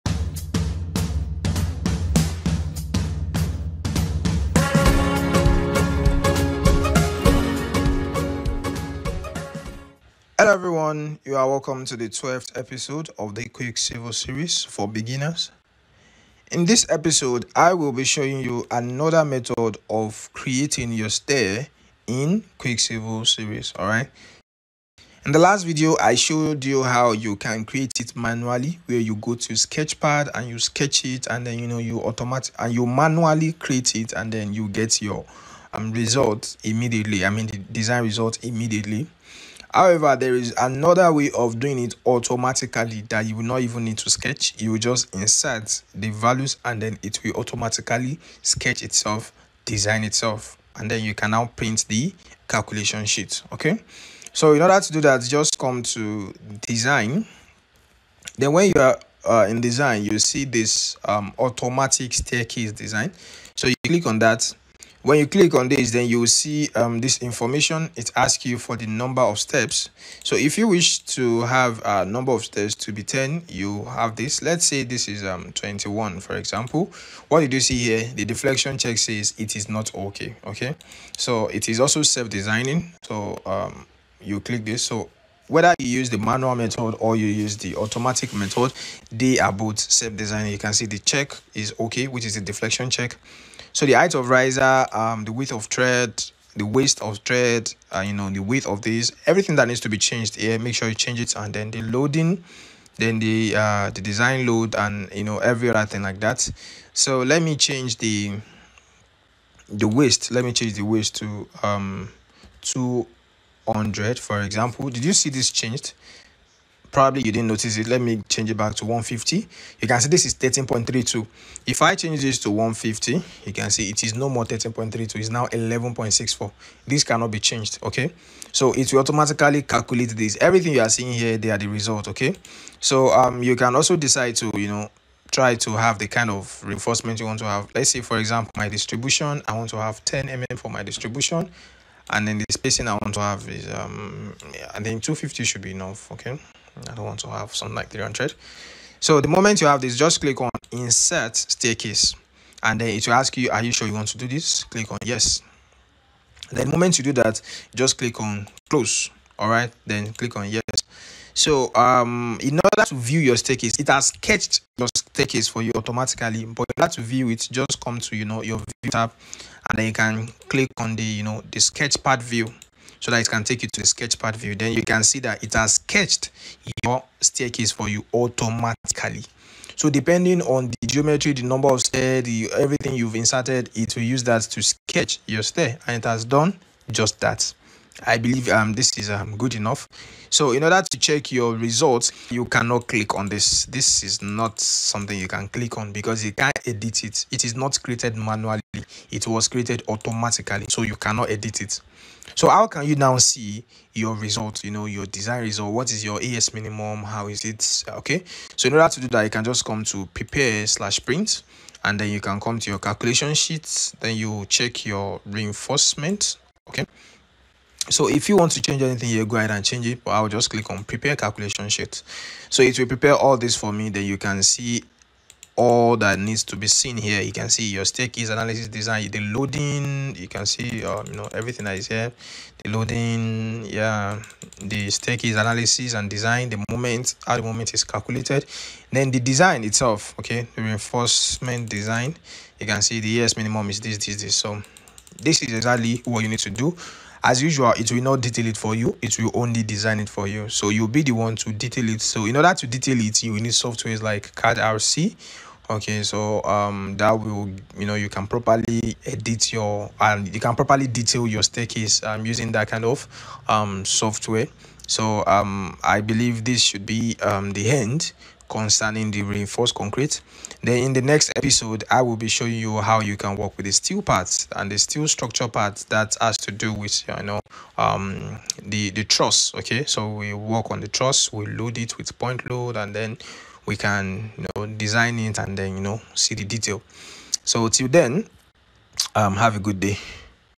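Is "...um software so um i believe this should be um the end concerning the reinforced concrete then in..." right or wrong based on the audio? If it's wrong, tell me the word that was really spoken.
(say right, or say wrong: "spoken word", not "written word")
right.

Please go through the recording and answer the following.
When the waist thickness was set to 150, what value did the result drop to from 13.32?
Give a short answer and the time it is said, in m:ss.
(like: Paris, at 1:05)
11.64, at 2:05.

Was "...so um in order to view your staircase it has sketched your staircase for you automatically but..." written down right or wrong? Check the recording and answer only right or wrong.
right.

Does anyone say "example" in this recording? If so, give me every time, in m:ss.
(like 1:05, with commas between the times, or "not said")
1:16, 1:54, 2:18.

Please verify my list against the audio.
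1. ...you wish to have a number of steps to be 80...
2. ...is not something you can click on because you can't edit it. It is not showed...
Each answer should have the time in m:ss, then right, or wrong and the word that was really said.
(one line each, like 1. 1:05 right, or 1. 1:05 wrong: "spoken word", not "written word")
1. 1:10 wrong: "10", not "80"
2. 3:14 wrong: "created", not "showed".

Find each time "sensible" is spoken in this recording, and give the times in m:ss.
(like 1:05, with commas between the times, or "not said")
not said.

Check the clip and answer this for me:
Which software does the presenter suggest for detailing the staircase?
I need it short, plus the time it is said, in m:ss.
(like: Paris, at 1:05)
card rc, at 4:14.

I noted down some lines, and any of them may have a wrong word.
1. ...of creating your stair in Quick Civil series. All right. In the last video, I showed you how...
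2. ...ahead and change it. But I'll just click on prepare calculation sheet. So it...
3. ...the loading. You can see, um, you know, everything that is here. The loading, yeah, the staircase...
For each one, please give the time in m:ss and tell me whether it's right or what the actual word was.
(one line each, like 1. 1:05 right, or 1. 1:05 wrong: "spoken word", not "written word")
1. 0:19 right
2. 3:39 right
3. 3:49 right.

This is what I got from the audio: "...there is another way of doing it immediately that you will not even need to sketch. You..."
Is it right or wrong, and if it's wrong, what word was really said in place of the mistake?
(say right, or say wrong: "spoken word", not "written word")
wrong: "automatically", not "immediately".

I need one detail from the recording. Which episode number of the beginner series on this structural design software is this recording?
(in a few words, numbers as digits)
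12th.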